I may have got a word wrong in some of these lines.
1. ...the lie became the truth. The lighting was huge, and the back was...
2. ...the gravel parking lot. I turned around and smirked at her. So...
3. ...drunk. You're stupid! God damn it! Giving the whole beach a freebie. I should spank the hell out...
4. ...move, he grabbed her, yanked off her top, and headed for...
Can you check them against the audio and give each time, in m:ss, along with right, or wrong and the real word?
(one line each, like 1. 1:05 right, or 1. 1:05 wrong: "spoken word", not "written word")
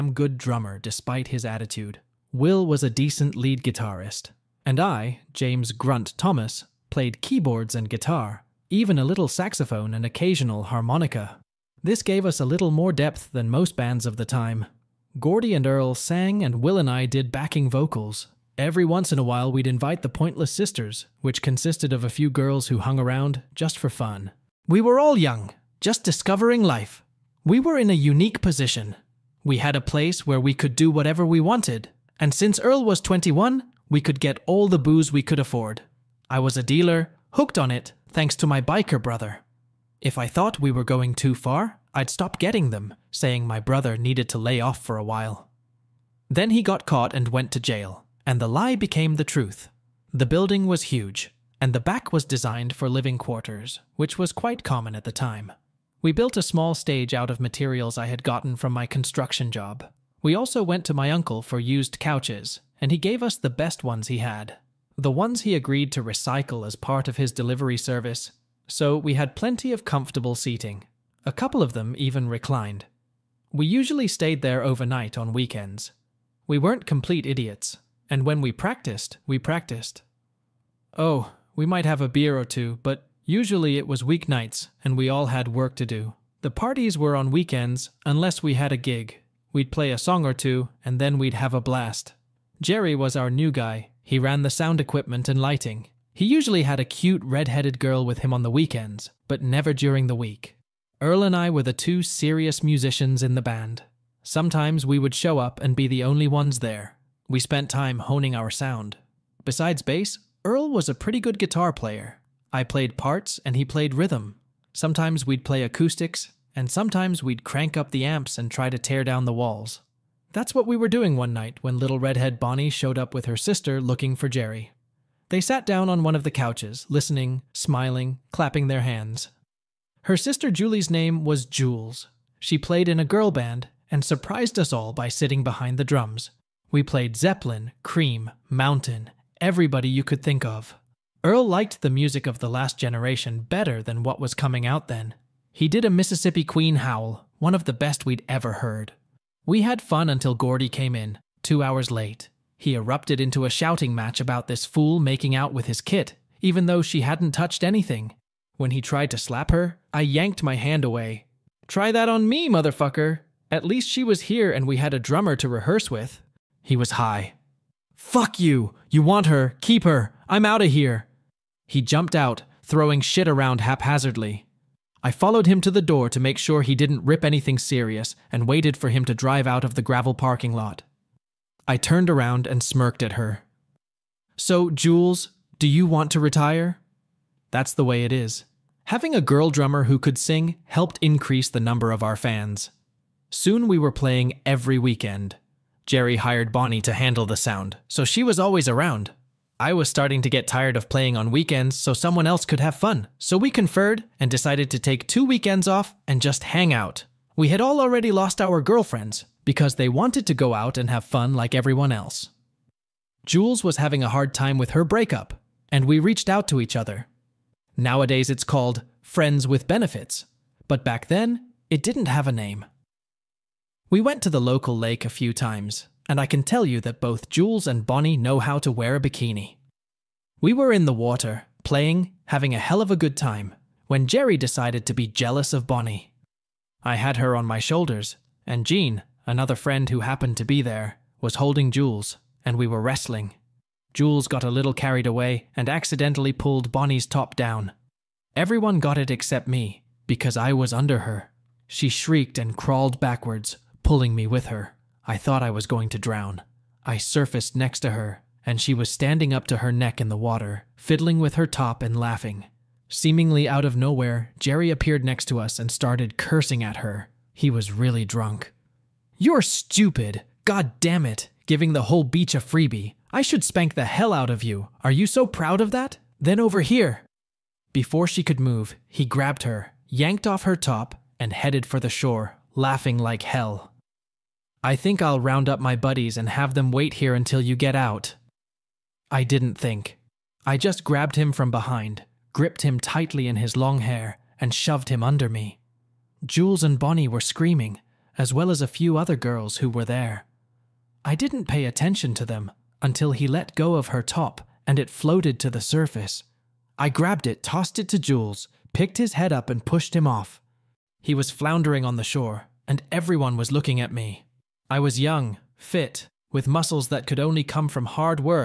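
1. 0:48 wrong: "building", not "lighting"
2. 2:59 right
3. 4:28 right
4. 4:38 right.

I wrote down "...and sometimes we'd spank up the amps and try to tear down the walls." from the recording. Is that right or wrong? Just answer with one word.
wrong.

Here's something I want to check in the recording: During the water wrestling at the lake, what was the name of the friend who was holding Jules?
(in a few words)
Jean.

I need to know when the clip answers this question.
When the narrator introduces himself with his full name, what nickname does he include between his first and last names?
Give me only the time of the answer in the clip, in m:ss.
0:05.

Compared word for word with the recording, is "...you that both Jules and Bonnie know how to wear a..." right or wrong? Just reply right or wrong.
right.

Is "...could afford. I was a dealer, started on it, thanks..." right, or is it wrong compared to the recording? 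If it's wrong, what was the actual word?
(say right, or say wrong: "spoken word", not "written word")
wrong: "hooked", not "started".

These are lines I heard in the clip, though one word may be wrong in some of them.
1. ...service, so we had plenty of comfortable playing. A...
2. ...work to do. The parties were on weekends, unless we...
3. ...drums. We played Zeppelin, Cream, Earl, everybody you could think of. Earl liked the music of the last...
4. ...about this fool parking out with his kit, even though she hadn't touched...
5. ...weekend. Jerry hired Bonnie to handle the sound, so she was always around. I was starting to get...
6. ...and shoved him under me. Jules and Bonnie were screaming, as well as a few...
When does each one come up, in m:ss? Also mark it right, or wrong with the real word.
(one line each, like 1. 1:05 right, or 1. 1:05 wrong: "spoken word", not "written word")
1. 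1:07 wrong: "seating", not "playing"
2. 1:25 right
3. 2:15 wrong: "Mountain", not "Earl"
4. 2:34 wrong: "making", not "parking"
5. 3:14 right
6. 4:54 right.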